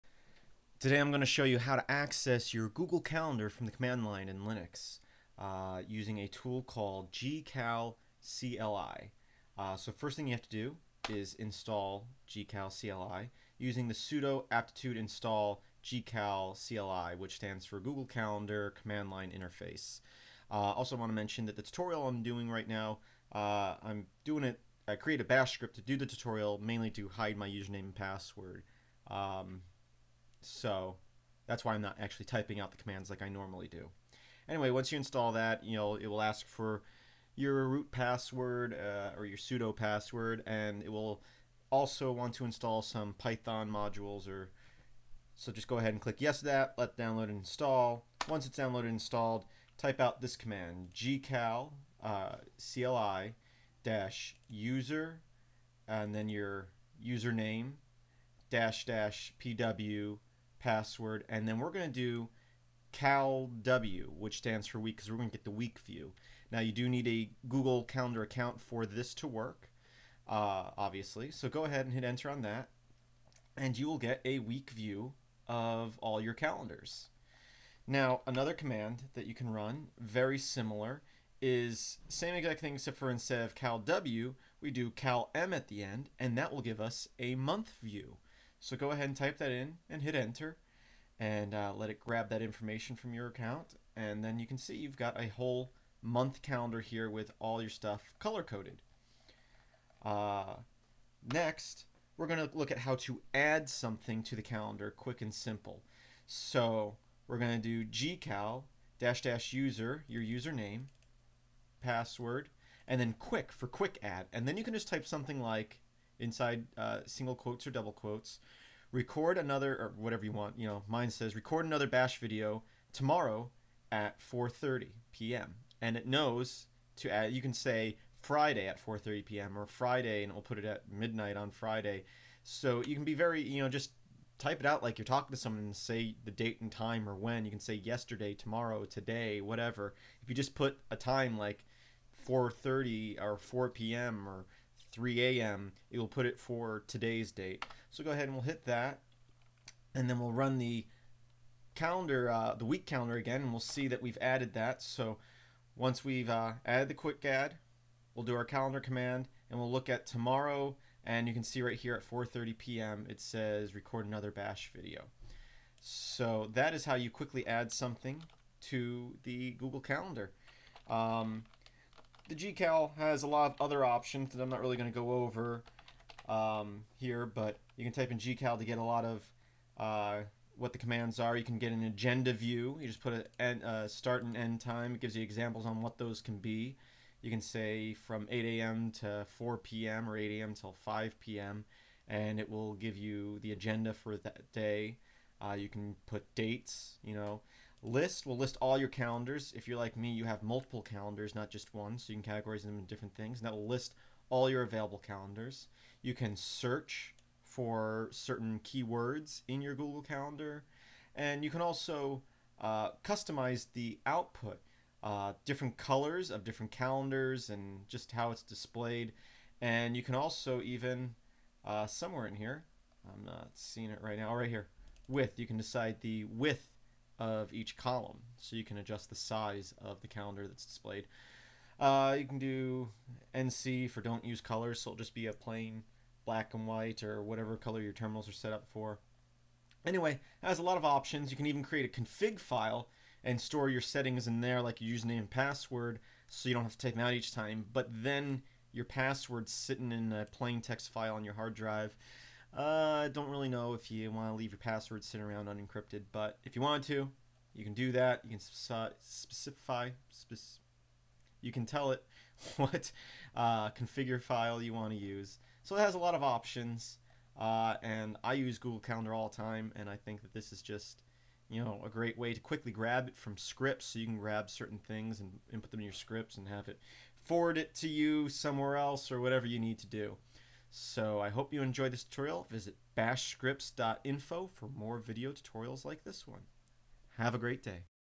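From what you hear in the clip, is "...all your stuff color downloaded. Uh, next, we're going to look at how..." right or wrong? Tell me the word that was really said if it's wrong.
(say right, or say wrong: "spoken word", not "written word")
wrong: "coded", not "downloaded".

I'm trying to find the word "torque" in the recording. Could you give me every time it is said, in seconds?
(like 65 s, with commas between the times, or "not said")
not said.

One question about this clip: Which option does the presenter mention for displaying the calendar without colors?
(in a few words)
NC.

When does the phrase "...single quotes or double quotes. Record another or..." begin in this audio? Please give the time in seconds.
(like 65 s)
117 s.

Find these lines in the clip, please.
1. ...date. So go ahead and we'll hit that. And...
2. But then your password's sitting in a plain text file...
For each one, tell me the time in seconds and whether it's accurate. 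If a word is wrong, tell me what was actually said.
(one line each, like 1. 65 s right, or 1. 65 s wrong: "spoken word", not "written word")
1. 147 s right
2. 247 s right.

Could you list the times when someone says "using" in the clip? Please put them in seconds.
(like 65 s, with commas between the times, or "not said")
5 s, 13 s.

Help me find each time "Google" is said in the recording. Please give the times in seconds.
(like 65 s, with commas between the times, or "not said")
2 s, 17 s, 67 s, 169 s, 209 s, 268 s.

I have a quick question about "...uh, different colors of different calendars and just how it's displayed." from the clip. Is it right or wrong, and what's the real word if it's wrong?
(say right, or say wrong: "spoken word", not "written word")
right.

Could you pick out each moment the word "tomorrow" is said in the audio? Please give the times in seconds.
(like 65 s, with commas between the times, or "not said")
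122 s, 138 s, 160 s.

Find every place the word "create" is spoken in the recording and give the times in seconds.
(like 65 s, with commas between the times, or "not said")
24 s, 241 s.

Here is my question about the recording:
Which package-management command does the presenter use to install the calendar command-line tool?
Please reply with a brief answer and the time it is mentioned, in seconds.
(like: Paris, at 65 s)
sudo aptitude install, at 13 s.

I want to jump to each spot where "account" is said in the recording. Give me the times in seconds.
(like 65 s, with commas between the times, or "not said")
68 s, 93 s.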